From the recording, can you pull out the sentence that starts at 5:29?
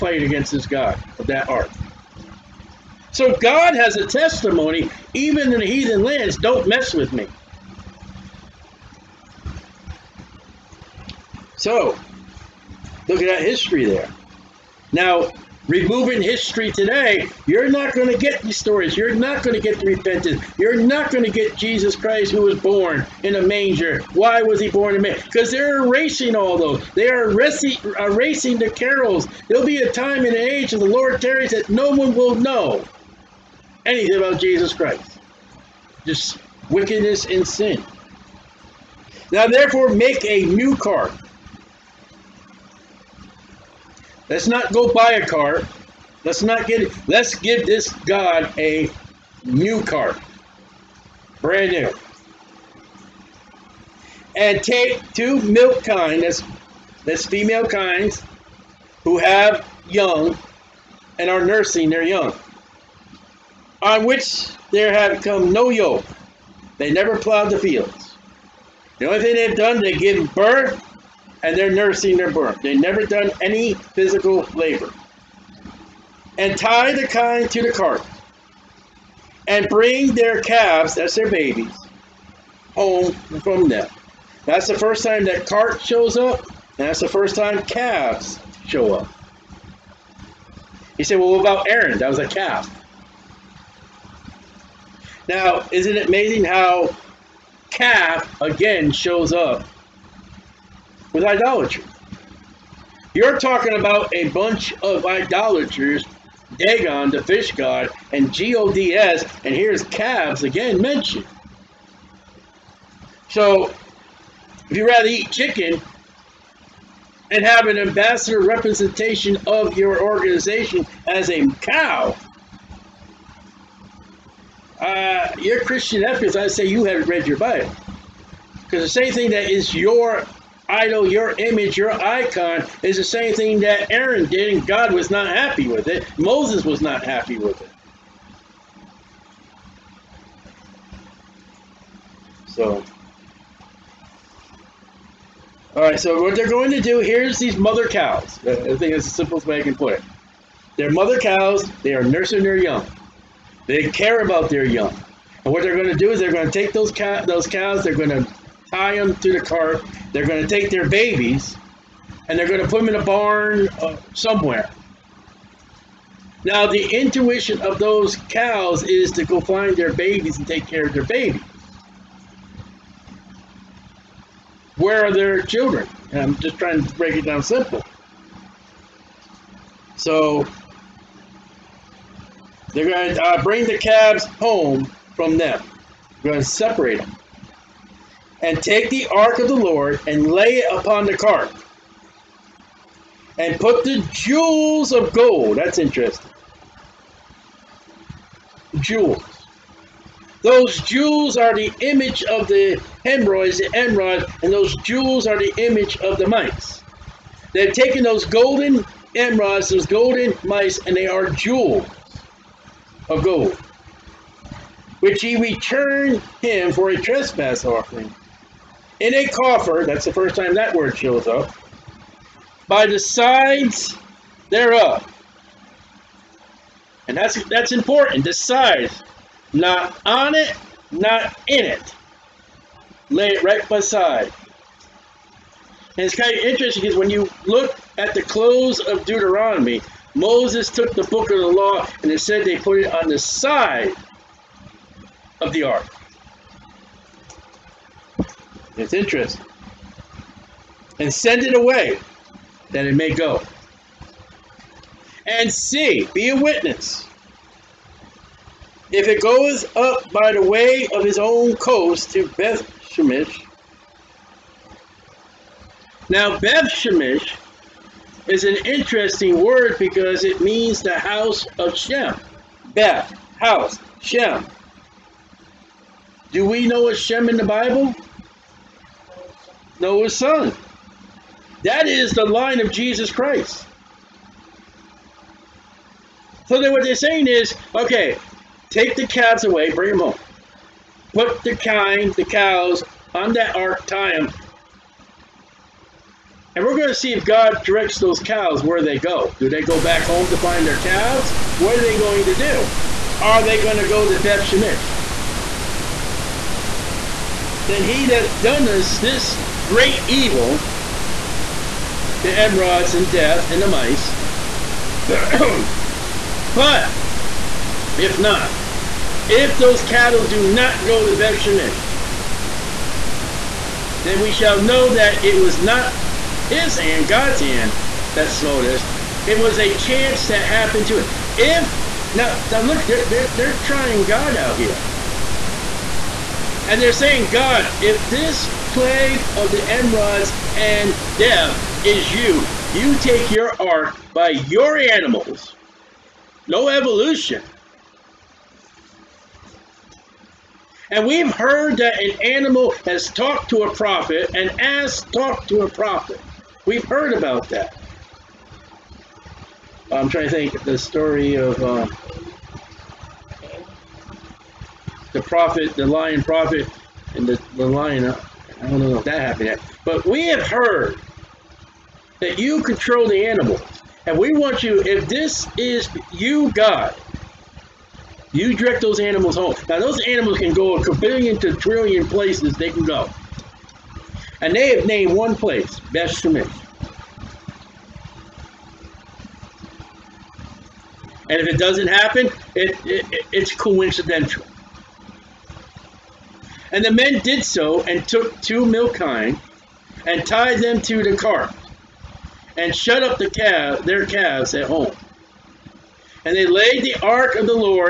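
It was a chance that happened to it.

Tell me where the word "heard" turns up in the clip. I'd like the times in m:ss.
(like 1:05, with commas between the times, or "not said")
5:51, 5:56, 6:10.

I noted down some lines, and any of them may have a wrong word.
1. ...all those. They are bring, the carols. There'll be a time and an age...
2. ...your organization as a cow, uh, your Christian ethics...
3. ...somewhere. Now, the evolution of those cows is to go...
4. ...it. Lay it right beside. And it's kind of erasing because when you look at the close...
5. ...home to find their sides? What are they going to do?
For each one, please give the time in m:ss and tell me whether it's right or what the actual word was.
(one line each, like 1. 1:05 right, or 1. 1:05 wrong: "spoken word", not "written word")
1. 0:26 wrong: "erasing", not "bring"
2. 1:59 right
3. 2:44 wrong: "intuition", not "evolution"
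4. 3:51 wrong: "interesting", not "erasing"
5. 5:00 wrong: "calves", not "sides".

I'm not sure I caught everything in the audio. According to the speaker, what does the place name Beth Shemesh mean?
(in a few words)
the house of Shem.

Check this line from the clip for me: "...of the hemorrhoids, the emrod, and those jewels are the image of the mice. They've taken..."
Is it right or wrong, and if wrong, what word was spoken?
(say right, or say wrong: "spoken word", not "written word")
right.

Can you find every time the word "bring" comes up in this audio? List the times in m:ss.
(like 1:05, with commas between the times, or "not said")
1:19, 3:03, 4:49.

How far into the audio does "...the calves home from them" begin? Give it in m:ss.
3:03.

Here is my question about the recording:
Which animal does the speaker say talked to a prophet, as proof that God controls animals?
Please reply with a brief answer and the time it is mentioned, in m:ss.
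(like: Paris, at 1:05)
an ass, at 5:54.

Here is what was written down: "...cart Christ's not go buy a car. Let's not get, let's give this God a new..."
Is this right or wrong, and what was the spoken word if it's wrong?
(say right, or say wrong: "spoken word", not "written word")
wrong: "Let", not "Christ".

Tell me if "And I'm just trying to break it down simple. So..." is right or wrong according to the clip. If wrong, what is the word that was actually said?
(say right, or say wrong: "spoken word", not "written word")
right.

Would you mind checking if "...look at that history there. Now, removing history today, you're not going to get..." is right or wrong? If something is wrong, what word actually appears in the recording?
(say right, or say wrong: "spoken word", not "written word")
right.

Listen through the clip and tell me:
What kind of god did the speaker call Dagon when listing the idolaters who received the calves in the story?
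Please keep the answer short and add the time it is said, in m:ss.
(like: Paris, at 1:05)
the fish god, at 1:47.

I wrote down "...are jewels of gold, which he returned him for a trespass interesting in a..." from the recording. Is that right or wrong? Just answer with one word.
wrong.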